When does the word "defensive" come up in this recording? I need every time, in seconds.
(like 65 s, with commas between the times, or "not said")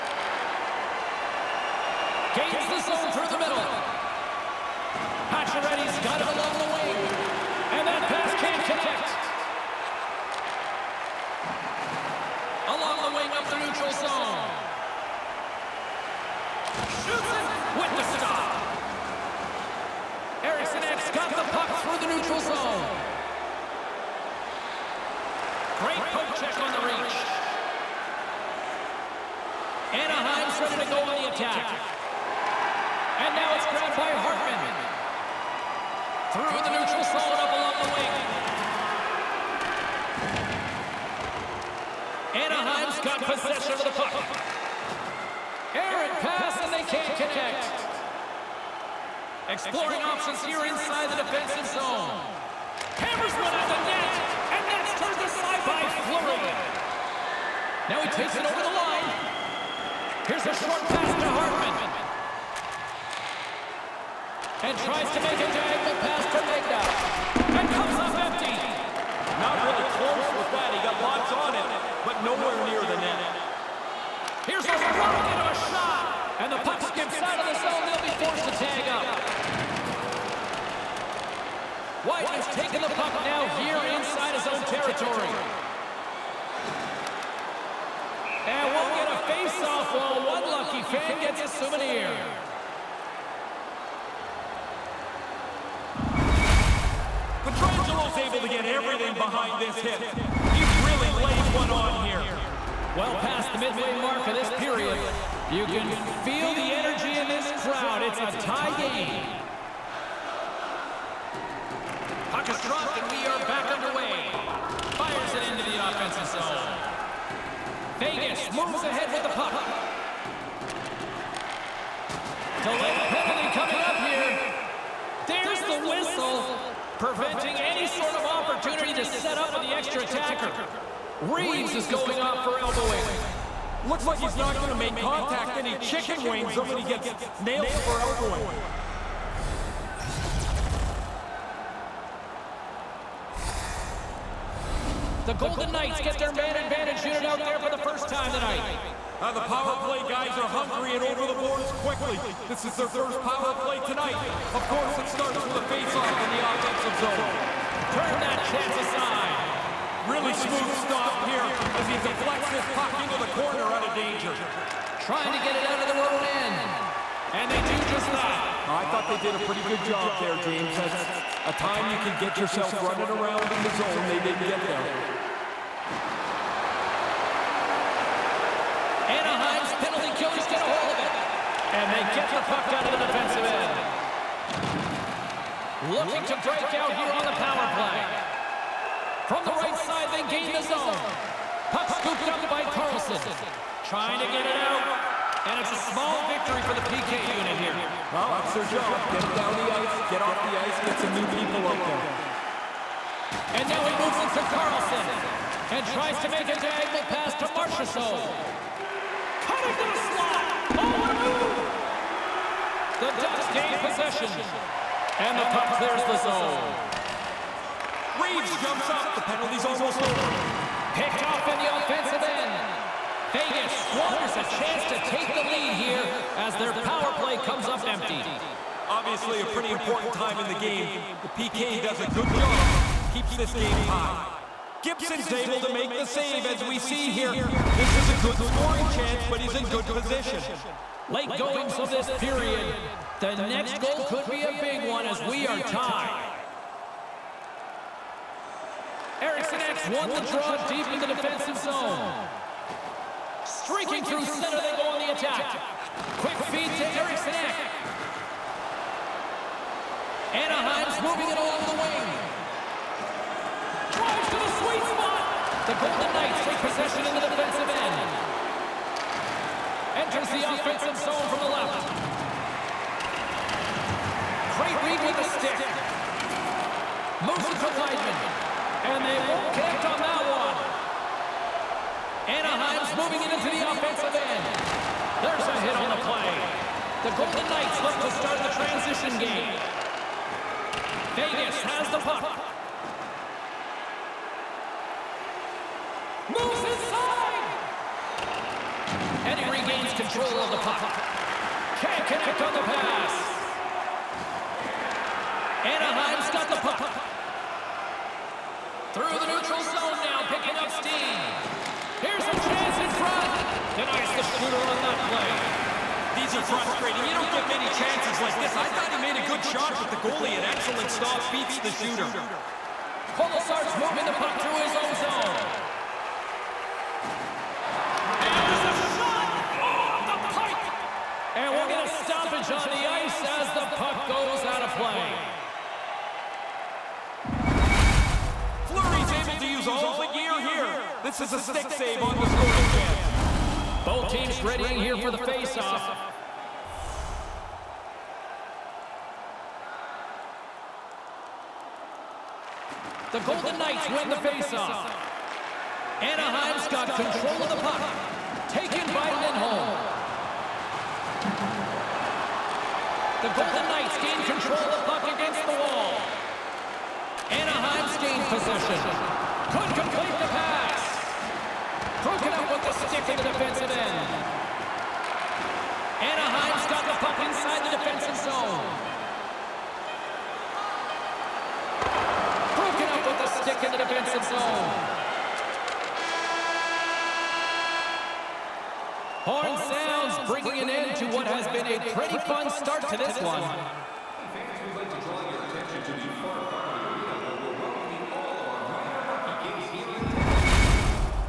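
51 s, 183 s, 251 s, 267 s, 373 s, 377 s, 383 s.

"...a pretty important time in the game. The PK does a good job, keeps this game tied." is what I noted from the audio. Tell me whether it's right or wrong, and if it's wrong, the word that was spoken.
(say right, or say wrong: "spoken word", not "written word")
right.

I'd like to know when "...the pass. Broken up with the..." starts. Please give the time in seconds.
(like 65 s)
370 s.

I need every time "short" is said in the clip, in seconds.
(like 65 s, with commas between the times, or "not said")
60 s.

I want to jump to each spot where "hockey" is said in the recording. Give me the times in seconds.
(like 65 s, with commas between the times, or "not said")
399 s.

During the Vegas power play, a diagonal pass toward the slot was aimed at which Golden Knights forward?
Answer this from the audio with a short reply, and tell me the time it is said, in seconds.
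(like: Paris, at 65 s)
Marchessault, at 207 s.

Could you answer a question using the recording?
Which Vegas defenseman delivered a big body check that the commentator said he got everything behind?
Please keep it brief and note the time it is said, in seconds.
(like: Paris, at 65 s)
Pietrangelo, at 97 s.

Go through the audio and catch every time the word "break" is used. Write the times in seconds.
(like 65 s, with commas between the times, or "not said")
186 s.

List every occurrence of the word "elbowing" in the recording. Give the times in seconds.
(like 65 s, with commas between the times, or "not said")
132 s, 137 s.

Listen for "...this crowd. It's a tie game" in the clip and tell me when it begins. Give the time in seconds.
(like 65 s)
107 s.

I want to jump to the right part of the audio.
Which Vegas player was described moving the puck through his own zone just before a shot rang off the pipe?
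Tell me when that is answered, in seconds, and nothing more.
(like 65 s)
323 s.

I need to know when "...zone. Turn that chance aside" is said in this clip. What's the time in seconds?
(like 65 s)
156 s.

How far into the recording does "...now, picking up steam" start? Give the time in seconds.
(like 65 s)
310 s.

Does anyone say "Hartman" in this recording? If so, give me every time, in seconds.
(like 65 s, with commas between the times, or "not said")
34 s, 61 s.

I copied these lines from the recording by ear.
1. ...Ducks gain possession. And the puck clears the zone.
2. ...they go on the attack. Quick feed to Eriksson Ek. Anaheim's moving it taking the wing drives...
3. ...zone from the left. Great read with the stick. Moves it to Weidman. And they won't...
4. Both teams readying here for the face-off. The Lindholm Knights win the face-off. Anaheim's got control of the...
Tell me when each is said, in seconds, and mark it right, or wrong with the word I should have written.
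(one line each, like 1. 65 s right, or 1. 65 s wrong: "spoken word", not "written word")
1. 213 s right
2. 254 s wrong: "along", not "taking"
3. 270 s right
4. 343 s wrong: "Golden", not "Lindholm".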